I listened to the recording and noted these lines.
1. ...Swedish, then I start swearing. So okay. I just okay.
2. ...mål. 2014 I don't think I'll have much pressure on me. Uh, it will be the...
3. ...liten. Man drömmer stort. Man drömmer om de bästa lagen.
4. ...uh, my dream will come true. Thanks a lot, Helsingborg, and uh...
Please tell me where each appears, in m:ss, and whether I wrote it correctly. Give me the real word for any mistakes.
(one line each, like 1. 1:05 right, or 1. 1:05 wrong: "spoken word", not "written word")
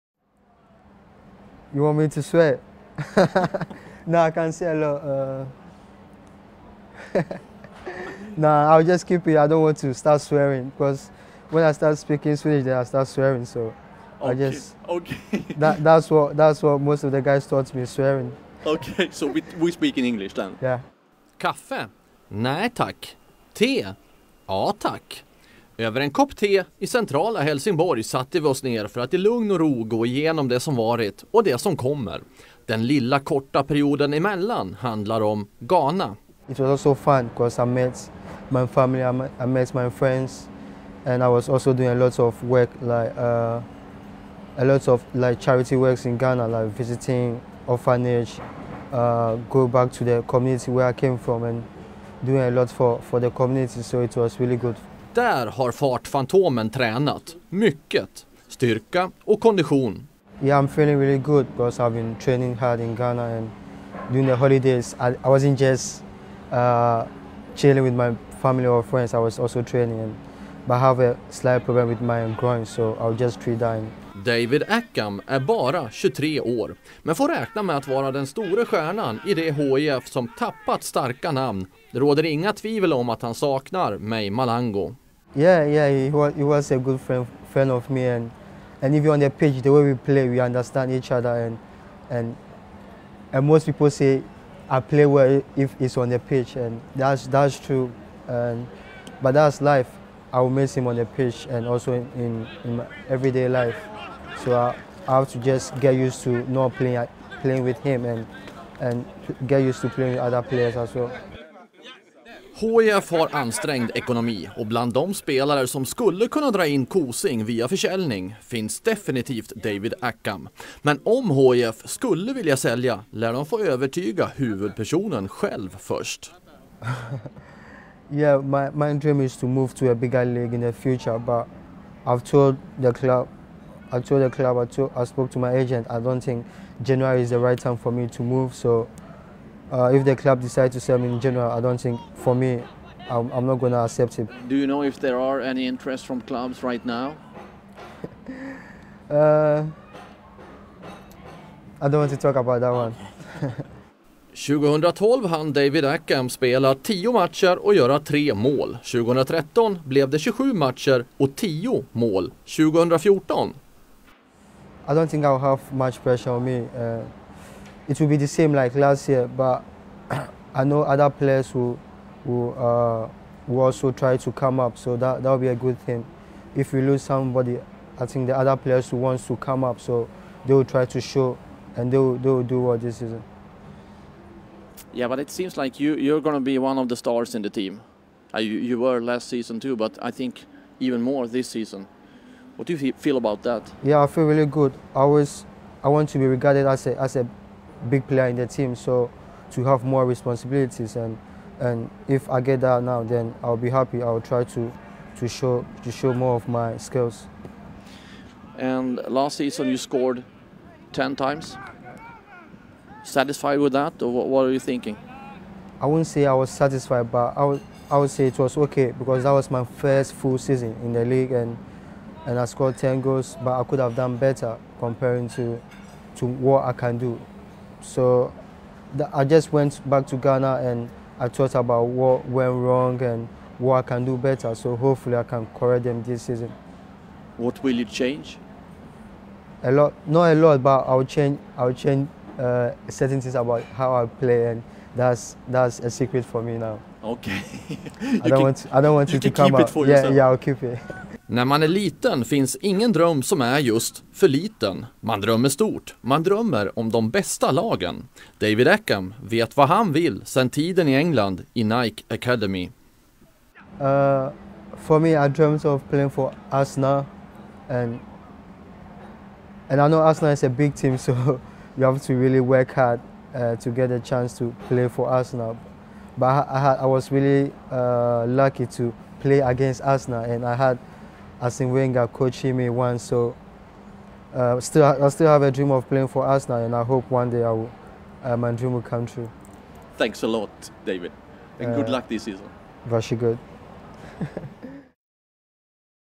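1. 0:12 right
2. 2:41 right
3. 4:14 right
4. 4:48 wrong: "David", not "Helsingborg".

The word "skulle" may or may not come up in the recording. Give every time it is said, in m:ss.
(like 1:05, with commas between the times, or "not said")
1:55, 2:01.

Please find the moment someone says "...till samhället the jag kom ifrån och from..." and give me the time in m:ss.
0:49.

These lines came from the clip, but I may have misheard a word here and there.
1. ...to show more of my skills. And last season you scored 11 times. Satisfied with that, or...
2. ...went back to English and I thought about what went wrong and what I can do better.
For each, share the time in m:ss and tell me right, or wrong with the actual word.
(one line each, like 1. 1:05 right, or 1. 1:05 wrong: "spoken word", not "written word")
1. 3:25 wrong: "10", not "11"
2. 3:49 wrong: "Ghana", not "English".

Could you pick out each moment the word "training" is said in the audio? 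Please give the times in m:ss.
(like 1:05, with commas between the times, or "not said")
1:02, 1:09.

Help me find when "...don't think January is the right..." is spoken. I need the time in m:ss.
2:15.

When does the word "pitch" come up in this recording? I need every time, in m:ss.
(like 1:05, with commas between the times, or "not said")
1:29, 1:36, 1:41.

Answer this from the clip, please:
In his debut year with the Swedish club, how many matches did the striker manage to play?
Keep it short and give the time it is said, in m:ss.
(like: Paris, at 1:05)
10, at 2:36.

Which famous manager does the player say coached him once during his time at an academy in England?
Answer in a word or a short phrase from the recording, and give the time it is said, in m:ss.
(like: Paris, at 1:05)
Arsene Wenger, at 4:41.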